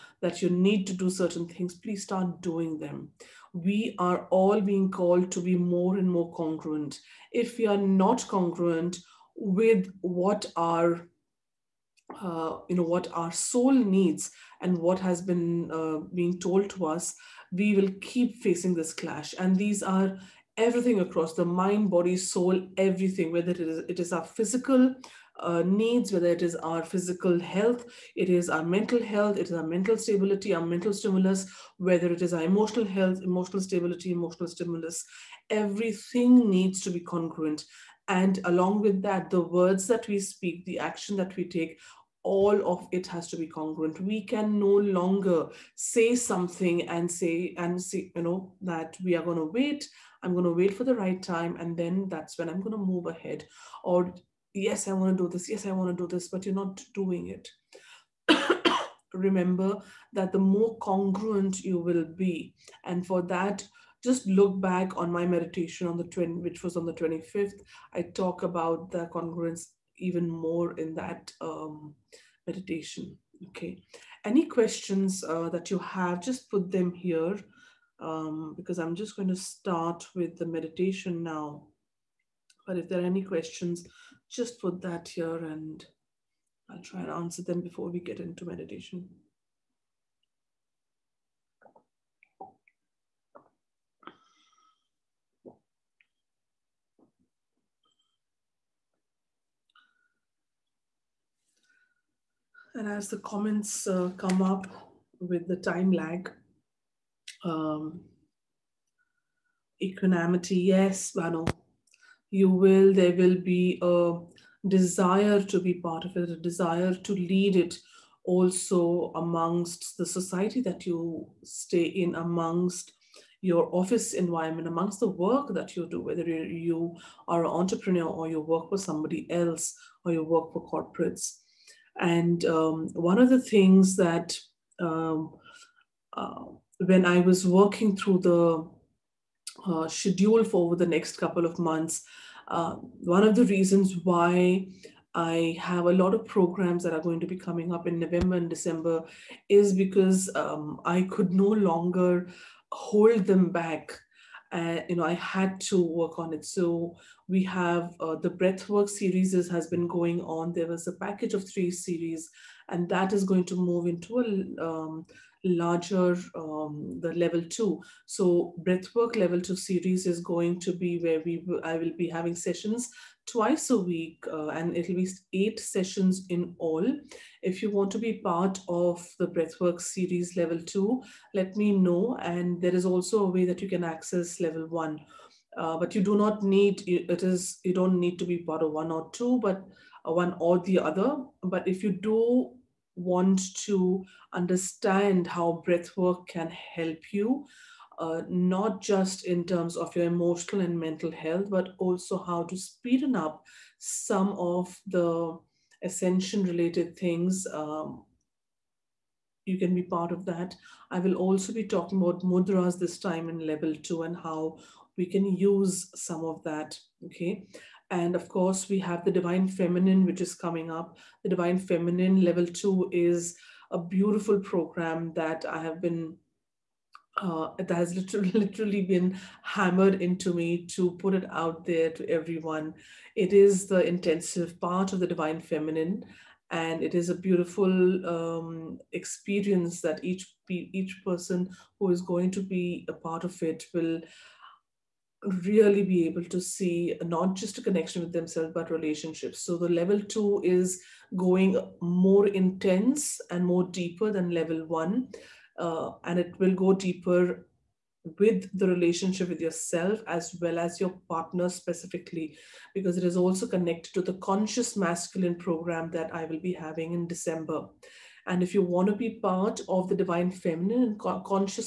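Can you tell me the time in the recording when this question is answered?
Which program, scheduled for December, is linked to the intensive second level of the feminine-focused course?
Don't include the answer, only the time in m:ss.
4:24.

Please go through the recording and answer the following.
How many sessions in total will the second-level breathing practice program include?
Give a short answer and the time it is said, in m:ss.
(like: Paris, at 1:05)
8, at 2:55.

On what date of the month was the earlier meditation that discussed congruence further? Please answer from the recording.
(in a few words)
25th.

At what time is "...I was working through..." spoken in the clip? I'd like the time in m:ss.
2:17.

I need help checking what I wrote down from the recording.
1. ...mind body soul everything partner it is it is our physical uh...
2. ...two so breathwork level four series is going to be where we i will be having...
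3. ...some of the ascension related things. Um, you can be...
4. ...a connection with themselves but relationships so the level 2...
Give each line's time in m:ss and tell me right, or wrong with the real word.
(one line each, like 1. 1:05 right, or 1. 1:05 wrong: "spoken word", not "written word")
1. 0:21 wrong: "whether", not "partner"
2. 2:47 wrong: "two", not "four"
3. 3:23 right
4. 4:07 right.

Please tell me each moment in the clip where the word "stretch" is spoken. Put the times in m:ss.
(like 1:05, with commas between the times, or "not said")
not said.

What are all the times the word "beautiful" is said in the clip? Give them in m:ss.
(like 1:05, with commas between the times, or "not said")
3:43, 3:57.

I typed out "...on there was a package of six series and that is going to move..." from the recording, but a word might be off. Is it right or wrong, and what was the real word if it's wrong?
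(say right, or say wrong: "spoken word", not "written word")
wrong: "three", not "six".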